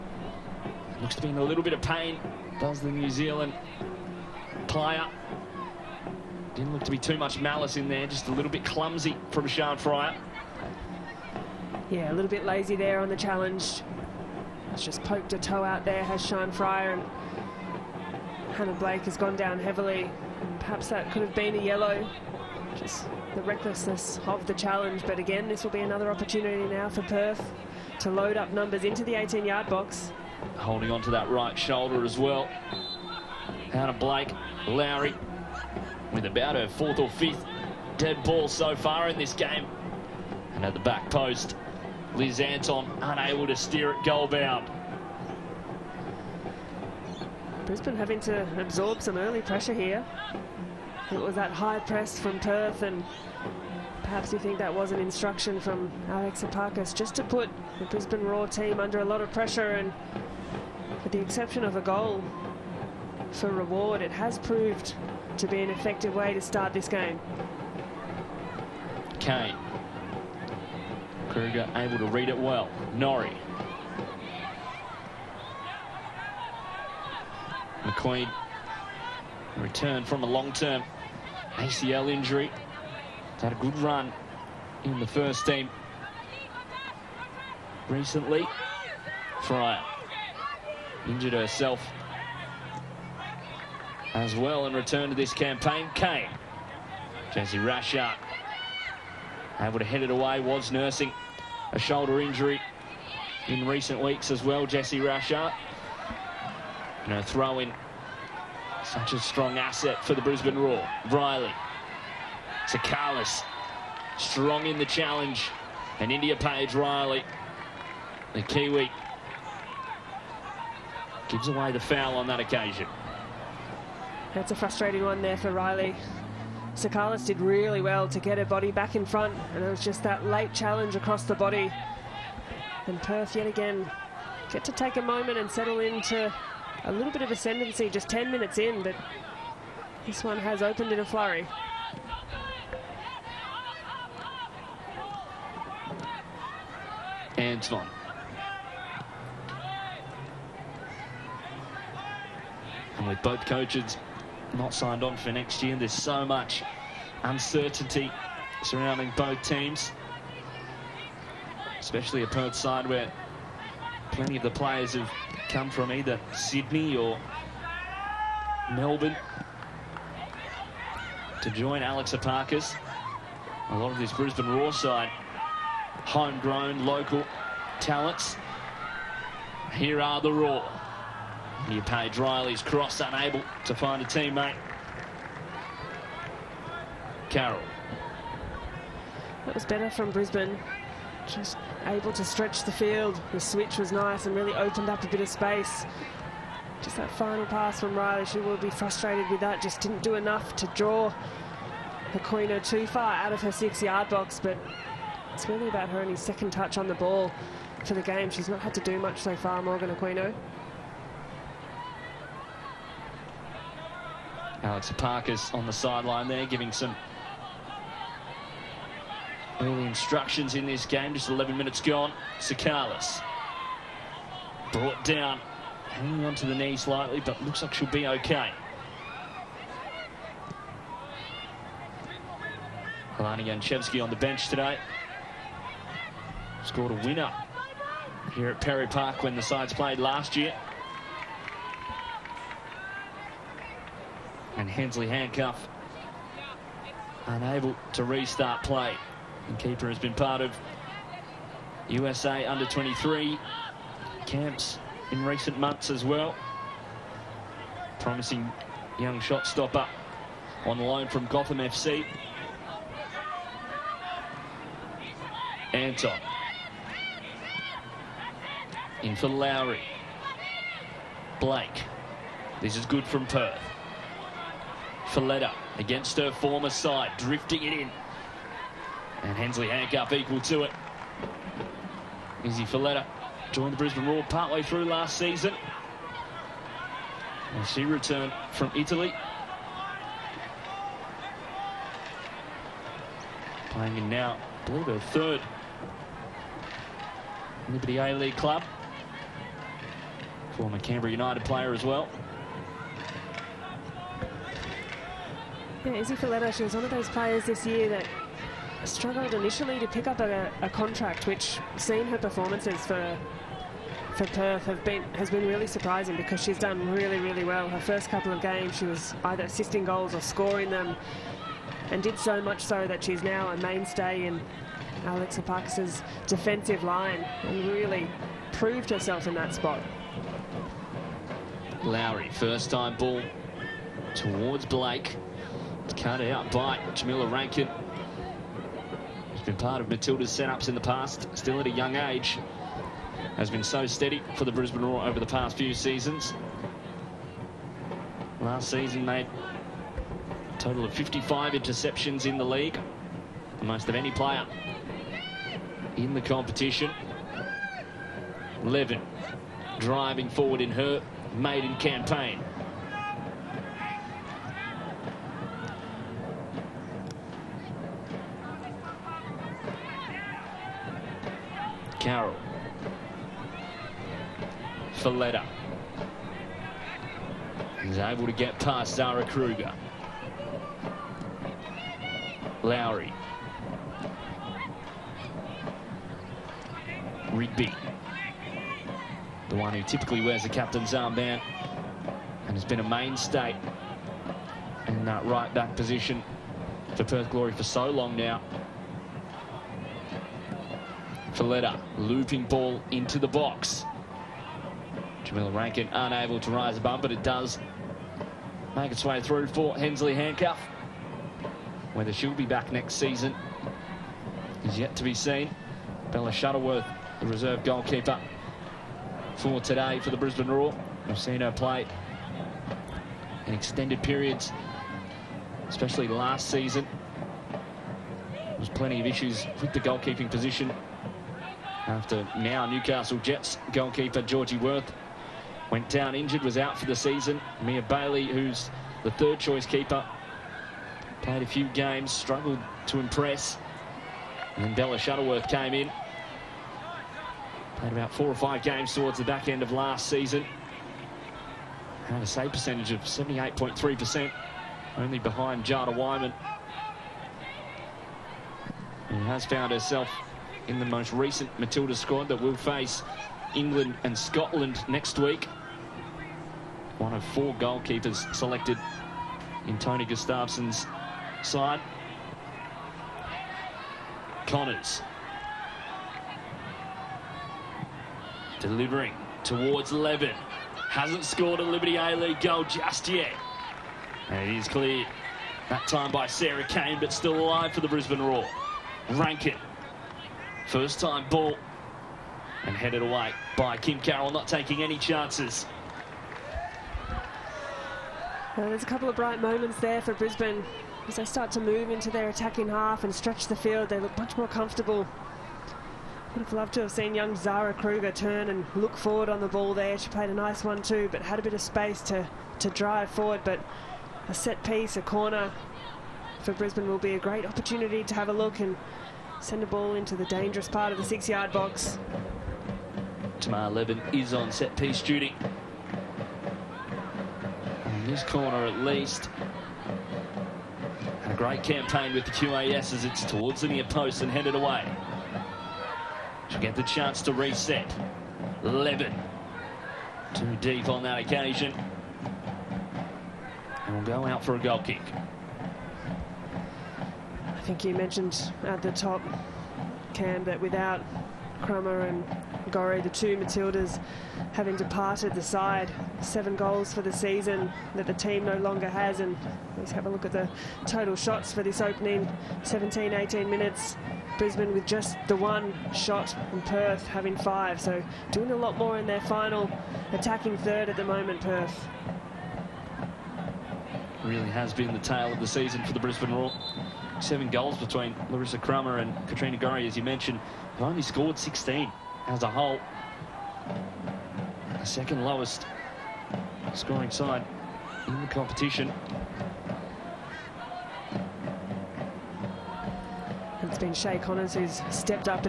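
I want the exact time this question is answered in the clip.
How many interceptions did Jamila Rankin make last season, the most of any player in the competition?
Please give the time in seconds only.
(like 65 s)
350 s.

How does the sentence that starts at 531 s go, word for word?
A great campaign with the QAS as it's towards the near post and headed away.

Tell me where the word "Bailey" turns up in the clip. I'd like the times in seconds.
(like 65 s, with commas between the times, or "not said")
437 s.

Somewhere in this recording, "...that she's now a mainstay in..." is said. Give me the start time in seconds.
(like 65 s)
322 s.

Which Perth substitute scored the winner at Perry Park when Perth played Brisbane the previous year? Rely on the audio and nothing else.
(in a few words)
Alana Jancevski.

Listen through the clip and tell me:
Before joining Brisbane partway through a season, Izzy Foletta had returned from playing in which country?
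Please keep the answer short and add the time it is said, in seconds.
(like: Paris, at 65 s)
Italy, at 288 s.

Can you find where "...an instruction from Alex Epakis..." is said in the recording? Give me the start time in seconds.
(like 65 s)
54 s.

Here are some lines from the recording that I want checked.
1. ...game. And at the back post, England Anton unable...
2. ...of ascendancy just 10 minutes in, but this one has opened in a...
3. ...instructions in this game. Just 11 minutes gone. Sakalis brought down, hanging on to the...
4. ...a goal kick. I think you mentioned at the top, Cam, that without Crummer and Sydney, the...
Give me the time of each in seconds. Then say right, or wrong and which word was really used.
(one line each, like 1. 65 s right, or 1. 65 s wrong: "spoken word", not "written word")
1. 39 s wrong: "Liz", not "England"
2. 137 s right
3. 219 s right
4. 544 s wrong: "Gore", not "Sydney".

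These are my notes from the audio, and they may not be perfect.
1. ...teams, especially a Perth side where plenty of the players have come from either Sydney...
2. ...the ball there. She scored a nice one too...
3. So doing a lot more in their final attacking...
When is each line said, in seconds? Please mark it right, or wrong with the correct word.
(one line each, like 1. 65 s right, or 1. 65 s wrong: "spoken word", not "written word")
1. 159 s right
2. 509 s wrong: "played", not "scored"
3. 567 s right.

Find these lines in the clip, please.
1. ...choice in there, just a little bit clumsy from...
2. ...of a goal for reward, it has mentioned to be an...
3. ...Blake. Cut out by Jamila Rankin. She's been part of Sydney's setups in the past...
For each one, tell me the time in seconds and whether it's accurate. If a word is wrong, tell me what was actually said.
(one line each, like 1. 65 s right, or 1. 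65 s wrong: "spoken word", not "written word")
1. 7 s wrong: "malice", not "choice"
2. 61 s wrong: "proved", not "mentioned"
3. 334 s wrong: "Matilda", not "Sydney".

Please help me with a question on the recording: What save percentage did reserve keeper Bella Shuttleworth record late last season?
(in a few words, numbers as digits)
78.3%.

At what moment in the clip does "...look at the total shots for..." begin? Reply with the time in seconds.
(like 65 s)
560 s.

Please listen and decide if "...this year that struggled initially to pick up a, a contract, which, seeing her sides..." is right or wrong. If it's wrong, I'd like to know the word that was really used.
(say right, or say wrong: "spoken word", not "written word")
wrong: "performances", not "sides".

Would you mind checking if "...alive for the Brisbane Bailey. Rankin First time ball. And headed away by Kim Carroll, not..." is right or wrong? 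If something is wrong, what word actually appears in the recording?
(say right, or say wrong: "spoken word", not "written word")
wrong: "Roar", not "Bailey".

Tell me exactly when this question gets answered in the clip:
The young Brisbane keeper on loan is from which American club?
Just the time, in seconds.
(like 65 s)
261 s.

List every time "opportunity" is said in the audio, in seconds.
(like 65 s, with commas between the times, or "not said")
26 s, 517 s.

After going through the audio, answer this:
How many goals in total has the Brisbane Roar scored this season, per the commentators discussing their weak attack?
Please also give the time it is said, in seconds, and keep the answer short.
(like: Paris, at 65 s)
16, at 581 s.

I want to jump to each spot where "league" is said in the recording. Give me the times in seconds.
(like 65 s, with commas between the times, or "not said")
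297 s, 352 s, 481 s.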